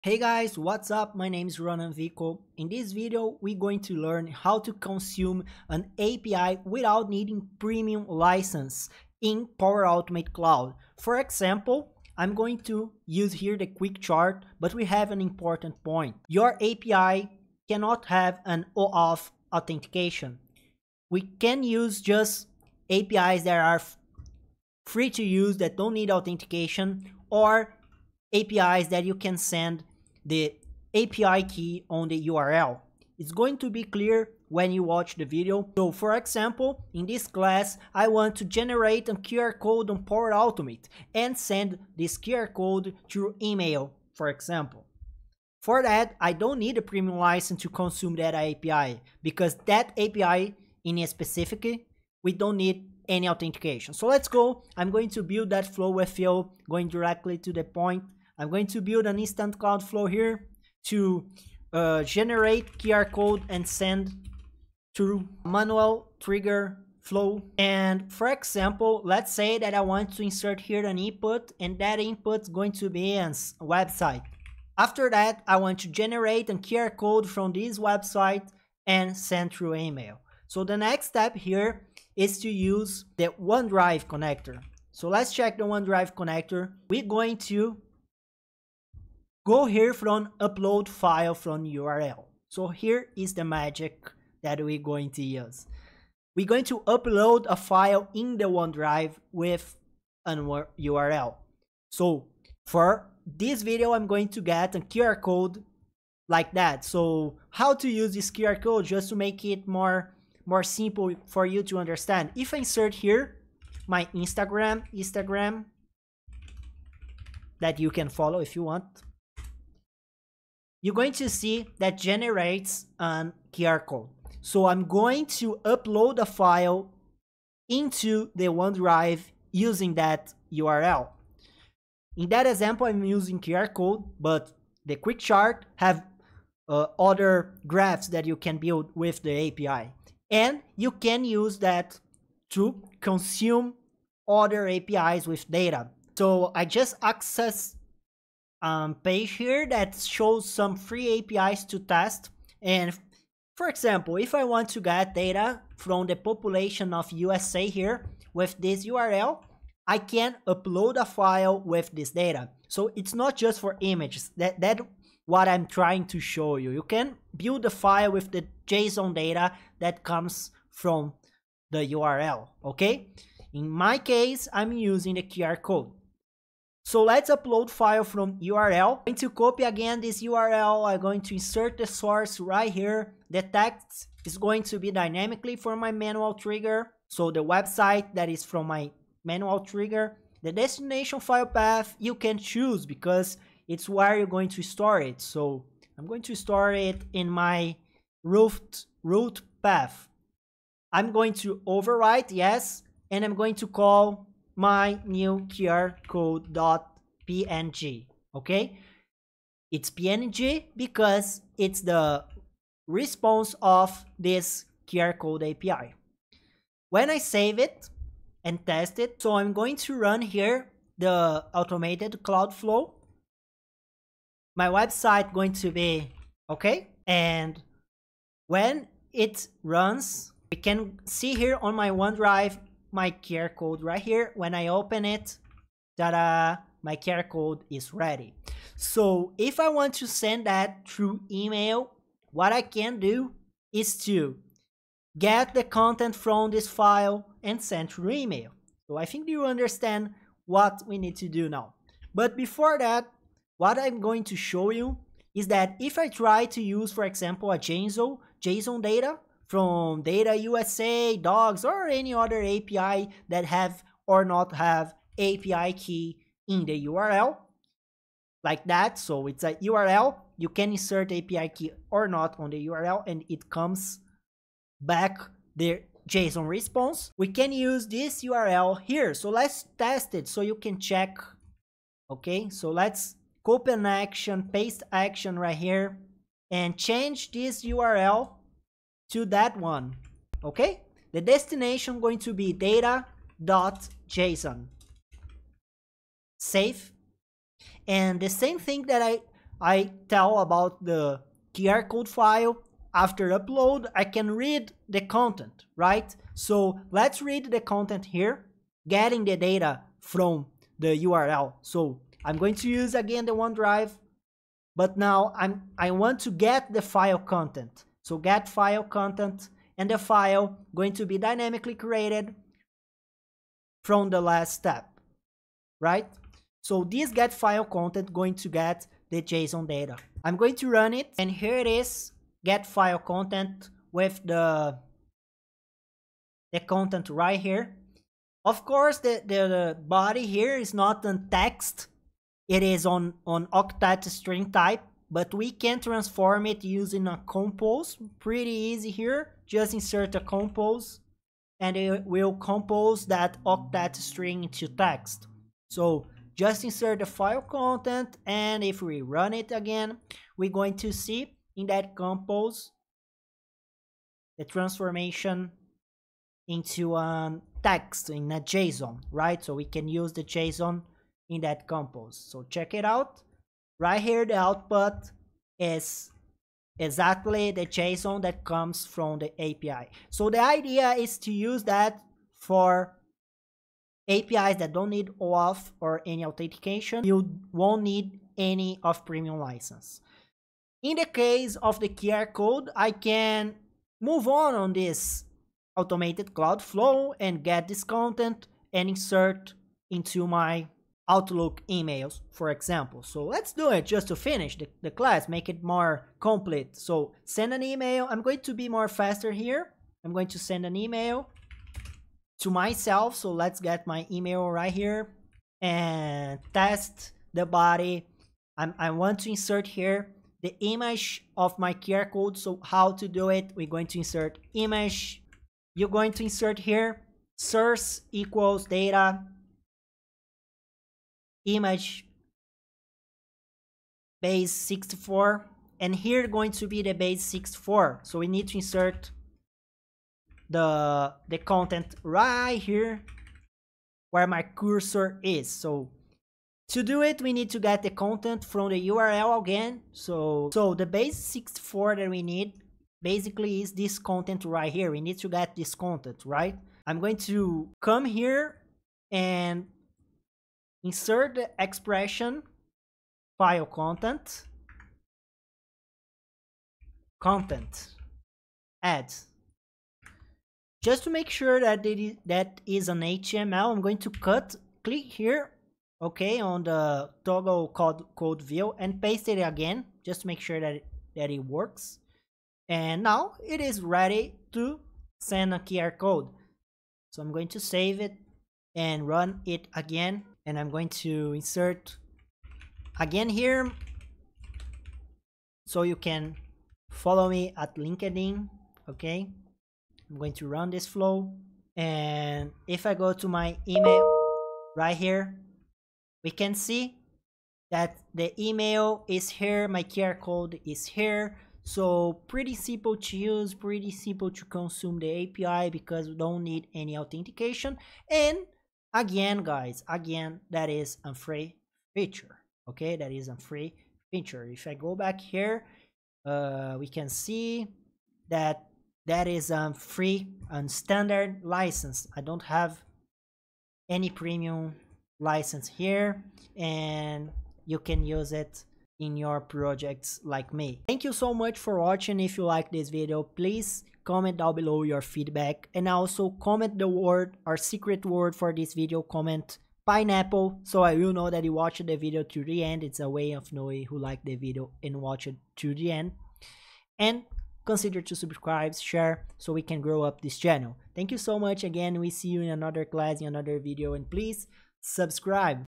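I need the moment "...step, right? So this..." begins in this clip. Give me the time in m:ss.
5:24.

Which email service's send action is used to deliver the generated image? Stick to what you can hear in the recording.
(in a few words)
Outlook.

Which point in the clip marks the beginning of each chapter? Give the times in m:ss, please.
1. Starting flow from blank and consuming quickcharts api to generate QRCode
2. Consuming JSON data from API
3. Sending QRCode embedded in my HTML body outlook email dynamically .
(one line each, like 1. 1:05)
1. 1:00
2. 4:10
3. 6:25.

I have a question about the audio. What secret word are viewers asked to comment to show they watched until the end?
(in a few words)
pineapple.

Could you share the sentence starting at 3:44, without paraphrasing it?
My website going to be okay, and when it runs, we can see here on my OneDrive my QR code right here.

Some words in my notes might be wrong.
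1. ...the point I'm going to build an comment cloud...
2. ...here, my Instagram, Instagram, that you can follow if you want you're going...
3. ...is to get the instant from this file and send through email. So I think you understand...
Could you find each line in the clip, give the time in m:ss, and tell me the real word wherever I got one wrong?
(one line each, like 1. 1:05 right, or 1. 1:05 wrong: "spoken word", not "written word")
1. 0:57 wrong: "instant", not "comment"
2. 1:52 right
3. 4:03 wrong: "content", not "instant".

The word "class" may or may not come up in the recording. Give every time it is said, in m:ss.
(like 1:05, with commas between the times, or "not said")
0:37, 6:44, 9:22.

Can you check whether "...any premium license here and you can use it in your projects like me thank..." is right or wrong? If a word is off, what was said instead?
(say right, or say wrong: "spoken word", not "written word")
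right.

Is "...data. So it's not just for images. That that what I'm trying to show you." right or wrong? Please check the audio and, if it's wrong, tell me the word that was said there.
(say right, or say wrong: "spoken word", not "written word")
right.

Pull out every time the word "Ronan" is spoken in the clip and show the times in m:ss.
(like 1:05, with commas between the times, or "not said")
0:01.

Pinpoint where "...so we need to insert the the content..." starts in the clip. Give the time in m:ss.
7:18.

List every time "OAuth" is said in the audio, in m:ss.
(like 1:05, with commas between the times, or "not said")
0:18, 6:25.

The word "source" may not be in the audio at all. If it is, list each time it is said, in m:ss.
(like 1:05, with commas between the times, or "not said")
3:01, 7:07.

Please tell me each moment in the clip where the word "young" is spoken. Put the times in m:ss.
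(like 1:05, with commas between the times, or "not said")
not said.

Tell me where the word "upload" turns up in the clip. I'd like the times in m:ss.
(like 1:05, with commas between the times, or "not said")
1:30, 1:36, 2:05, 2:40, 2:57, 5:03.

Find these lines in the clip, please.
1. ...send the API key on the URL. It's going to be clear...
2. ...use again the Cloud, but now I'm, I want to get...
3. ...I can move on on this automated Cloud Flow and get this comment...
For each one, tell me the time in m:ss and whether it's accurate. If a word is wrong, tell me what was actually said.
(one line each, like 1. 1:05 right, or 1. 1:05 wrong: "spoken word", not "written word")
1. 0:29 right
2. 5:12 wrong: "OneDrive", not "Cloud"
3. 6:32 wrong: "content", not "comment".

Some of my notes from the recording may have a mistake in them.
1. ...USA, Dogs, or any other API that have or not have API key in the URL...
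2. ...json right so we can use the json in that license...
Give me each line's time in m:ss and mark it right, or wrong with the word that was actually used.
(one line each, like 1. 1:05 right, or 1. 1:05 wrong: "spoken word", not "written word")
1. 4:20 right
2. 6:08 wrong: "compose", not "license".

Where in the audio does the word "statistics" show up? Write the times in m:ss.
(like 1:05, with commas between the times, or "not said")
not said.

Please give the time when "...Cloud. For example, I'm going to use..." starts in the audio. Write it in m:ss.
0:10.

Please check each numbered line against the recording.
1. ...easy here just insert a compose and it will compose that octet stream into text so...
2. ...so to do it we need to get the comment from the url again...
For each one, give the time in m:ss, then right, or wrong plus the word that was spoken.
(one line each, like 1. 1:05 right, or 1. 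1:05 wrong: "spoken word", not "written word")
1. 5:48 right
2. 7:25 wrong: "content", not "comment".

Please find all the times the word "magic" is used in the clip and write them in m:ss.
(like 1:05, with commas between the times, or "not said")
1:33.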